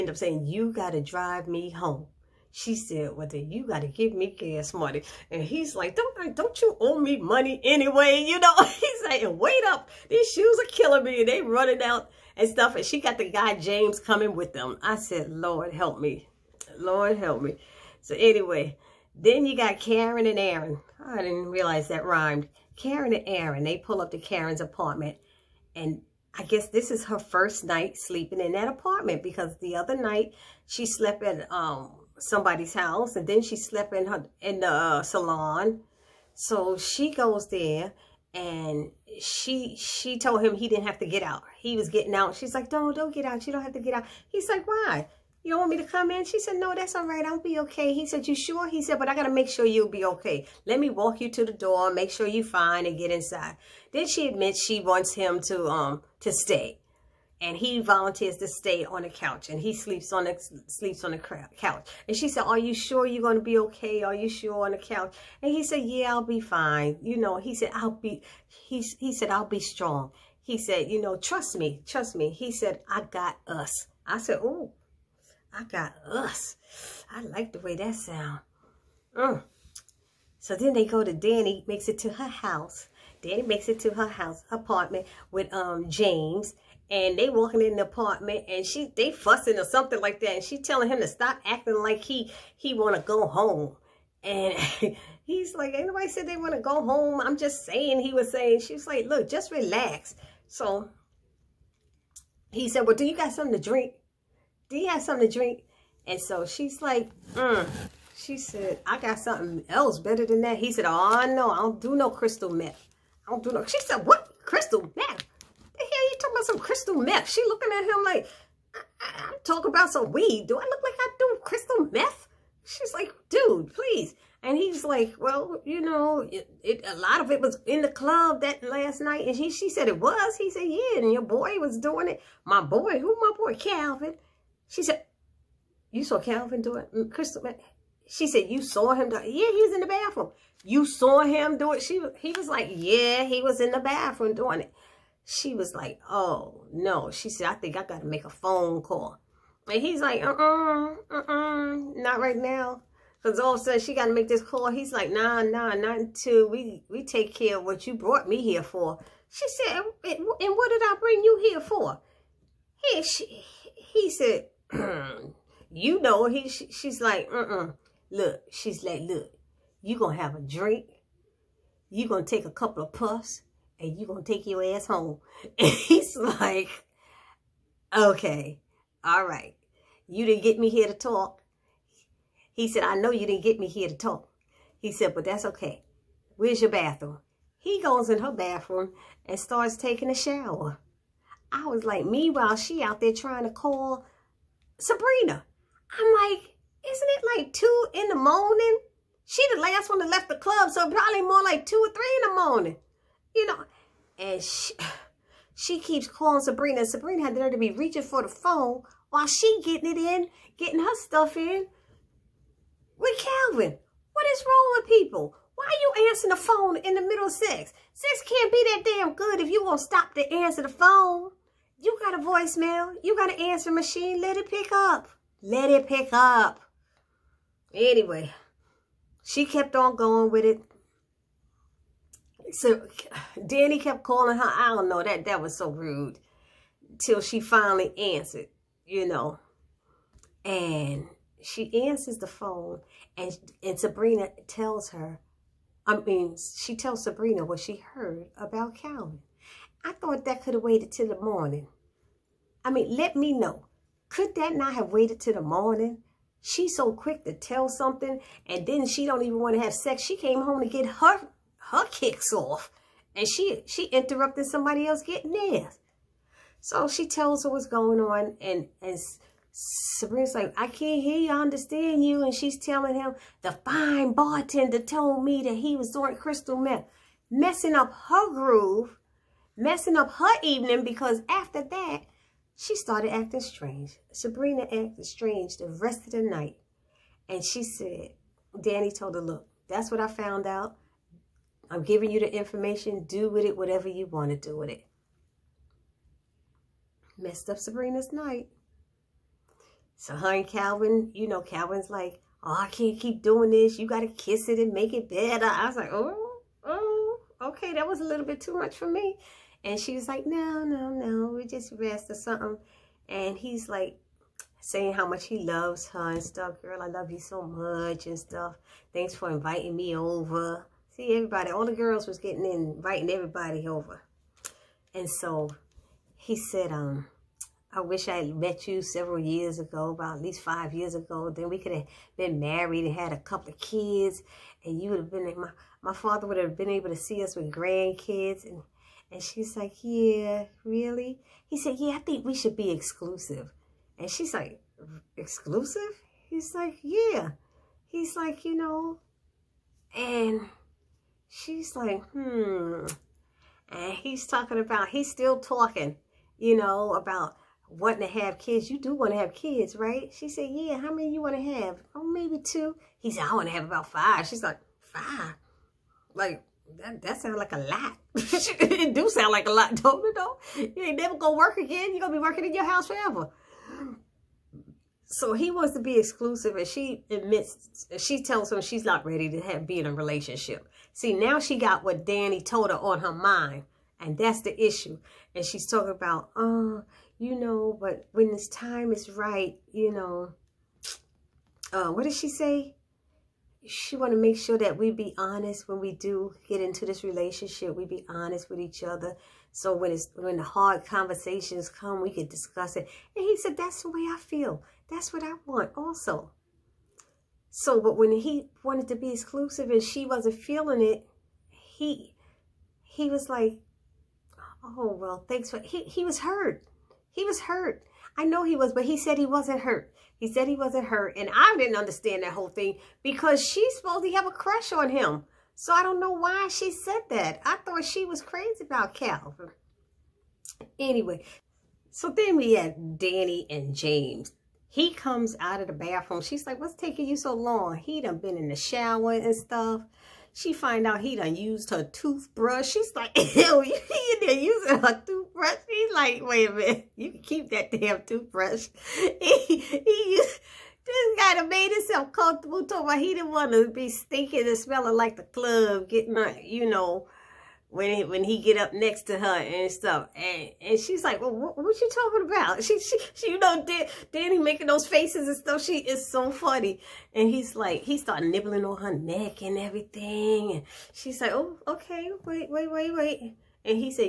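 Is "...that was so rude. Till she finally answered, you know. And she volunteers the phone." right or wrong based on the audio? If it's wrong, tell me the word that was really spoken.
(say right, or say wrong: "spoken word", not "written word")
wrong: "answers", not "volunteers".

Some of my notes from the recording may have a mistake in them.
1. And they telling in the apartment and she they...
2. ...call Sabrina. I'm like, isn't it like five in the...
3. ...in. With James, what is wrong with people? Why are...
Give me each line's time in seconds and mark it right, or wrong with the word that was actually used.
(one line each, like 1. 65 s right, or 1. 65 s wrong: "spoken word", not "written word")
1. 86 s wrong: "walking", not "telling"
2. 193 s wrong: "two", not "five"
3. 211 s wrong: "Calvin", not "James".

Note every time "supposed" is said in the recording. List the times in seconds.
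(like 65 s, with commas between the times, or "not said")
423 s.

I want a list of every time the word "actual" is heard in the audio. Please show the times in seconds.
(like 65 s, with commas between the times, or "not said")
not said.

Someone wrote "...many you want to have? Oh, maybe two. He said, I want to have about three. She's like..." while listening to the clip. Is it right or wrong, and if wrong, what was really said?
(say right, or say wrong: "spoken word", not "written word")
wrong: "five", not "three".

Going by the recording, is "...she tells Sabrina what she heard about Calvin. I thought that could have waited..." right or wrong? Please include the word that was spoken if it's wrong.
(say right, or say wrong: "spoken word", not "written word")
right.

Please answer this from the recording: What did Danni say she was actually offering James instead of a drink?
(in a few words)
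Weed.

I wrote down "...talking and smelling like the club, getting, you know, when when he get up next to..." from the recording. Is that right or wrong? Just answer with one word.
wrong.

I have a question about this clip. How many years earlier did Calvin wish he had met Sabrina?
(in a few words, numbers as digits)
5.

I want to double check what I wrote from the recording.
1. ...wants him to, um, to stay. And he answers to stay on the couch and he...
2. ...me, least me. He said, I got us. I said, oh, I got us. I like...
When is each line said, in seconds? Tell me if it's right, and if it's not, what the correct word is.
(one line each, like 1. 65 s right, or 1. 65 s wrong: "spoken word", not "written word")
1. 54 s wrong: "volunteers", not "answers"
2. 71 s wrong: "trust", not "least".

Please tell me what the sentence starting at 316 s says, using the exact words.
Girl, I love you so much and stuff.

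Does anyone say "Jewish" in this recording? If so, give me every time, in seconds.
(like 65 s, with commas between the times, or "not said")
not said.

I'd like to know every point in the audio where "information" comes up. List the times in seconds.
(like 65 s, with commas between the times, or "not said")
292 s.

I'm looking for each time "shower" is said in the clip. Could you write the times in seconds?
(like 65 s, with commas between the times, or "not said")
190 s, 438 s.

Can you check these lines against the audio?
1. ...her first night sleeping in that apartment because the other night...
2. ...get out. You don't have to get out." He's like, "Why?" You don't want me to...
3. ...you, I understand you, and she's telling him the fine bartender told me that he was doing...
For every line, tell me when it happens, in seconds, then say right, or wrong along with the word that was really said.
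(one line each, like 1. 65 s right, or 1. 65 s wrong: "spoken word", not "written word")
1. 27 s right
2. 43 s right
3. 271 s right.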